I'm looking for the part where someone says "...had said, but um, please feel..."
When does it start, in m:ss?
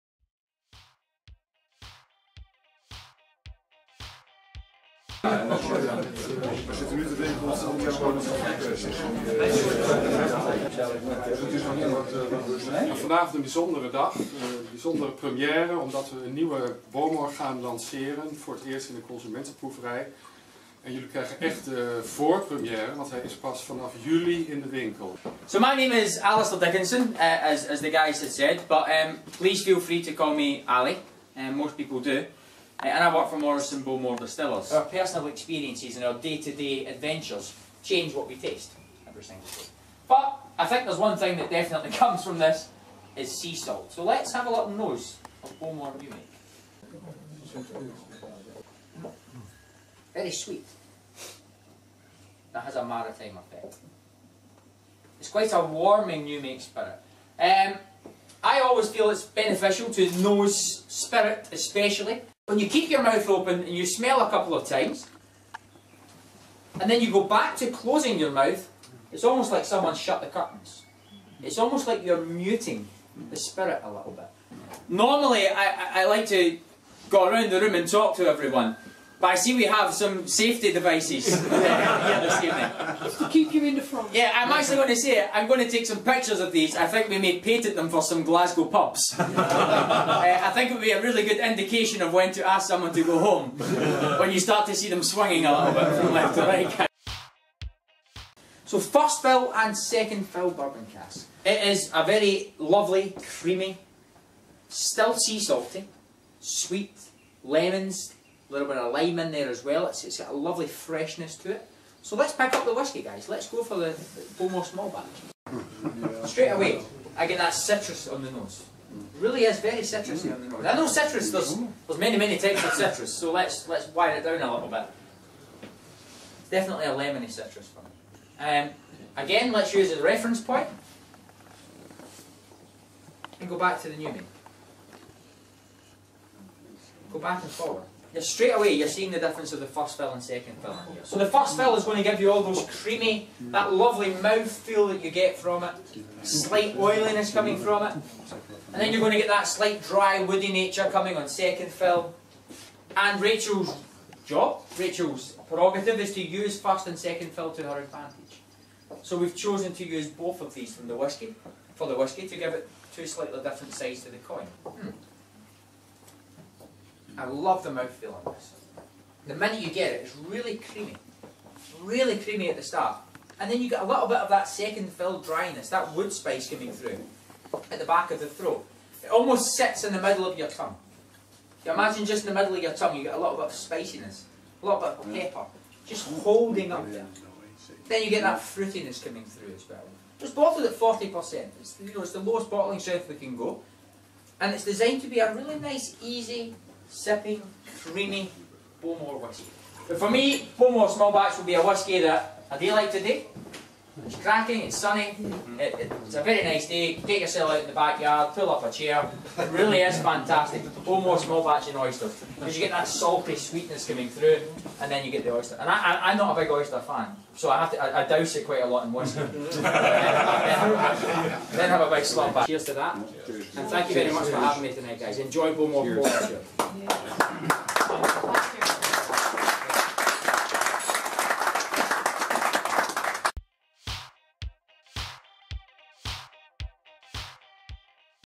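0:28.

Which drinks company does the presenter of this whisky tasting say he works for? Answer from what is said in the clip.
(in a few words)
Morrison Bowmore Distillers.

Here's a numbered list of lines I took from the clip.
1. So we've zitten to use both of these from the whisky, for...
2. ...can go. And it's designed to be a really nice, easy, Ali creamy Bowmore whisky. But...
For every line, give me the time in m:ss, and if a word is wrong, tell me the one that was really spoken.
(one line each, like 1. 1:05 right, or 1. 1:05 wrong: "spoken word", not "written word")
1. 2:39 wrong: "chosen", not "zitten"
2. 3:13 wrong: "Sipping", not "Ali".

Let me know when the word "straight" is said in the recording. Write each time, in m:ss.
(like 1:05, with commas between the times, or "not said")
1:56, 2:18.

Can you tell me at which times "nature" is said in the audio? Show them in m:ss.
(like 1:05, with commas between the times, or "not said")
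2:30.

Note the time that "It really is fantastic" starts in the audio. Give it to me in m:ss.
3:29.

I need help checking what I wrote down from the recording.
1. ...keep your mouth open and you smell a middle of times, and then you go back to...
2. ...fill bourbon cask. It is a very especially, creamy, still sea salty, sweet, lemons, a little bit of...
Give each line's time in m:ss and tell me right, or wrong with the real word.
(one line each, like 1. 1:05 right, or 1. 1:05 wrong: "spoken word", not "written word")
1. 1:02 wrong: "couple", not "middle"
2. 1:40 wrong: "lovely", not "especially".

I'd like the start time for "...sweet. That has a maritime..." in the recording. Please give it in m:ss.
0:50.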